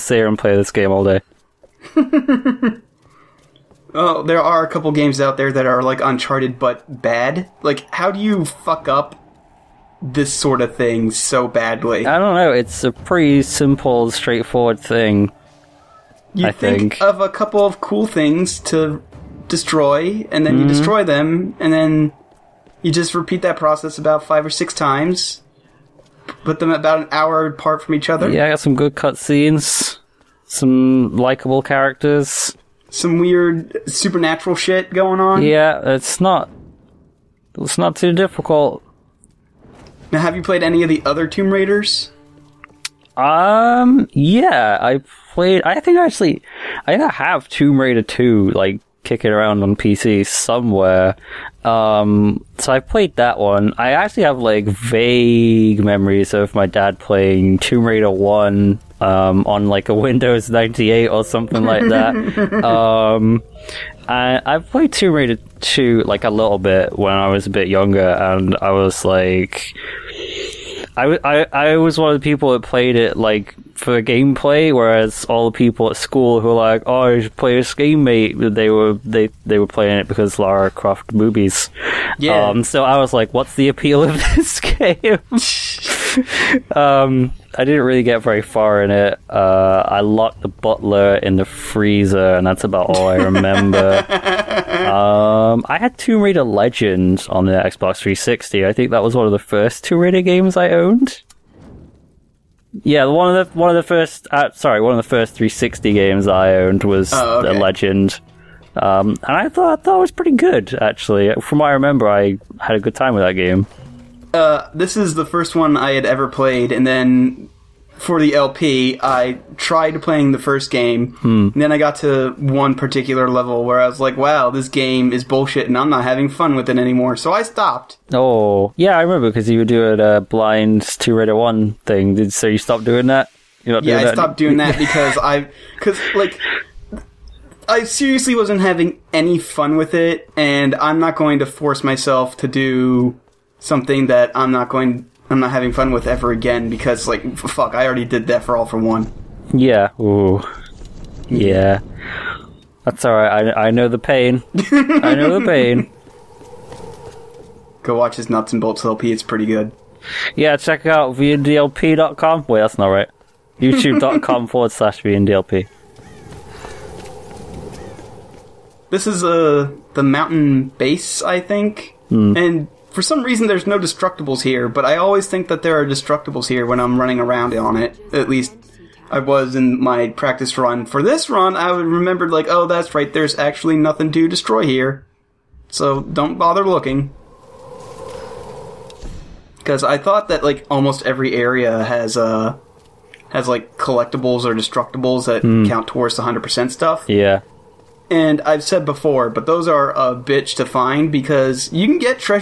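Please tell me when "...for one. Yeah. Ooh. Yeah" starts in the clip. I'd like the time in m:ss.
2:28.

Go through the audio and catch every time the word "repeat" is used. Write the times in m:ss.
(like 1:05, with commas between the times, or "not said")
0:23.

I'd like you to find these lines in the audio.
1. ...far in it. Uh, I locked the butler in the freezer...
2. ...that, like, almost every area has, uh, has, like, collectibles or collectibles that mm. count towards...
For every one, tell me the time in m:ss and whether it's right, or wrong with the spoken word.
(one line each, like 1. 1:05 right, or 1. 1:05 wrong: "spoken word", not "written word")
1. 1:28 right
2. 3:10 wrong: "destructibles", not "collectibles".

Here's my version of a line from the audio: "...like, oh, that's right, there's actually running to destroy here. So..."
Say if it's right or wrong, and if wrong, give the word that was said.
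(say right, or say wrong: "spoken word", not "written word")
wrong: "nothing", not "running".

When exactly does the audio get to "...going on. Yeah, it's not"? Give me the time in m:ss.
0:34.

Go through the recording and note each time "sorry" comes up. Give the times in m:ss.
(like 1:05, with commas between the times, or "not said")
1:44.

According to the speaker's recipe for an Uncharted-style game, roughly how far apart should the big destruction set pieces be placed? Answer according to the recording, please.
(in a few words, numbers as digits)
an hour.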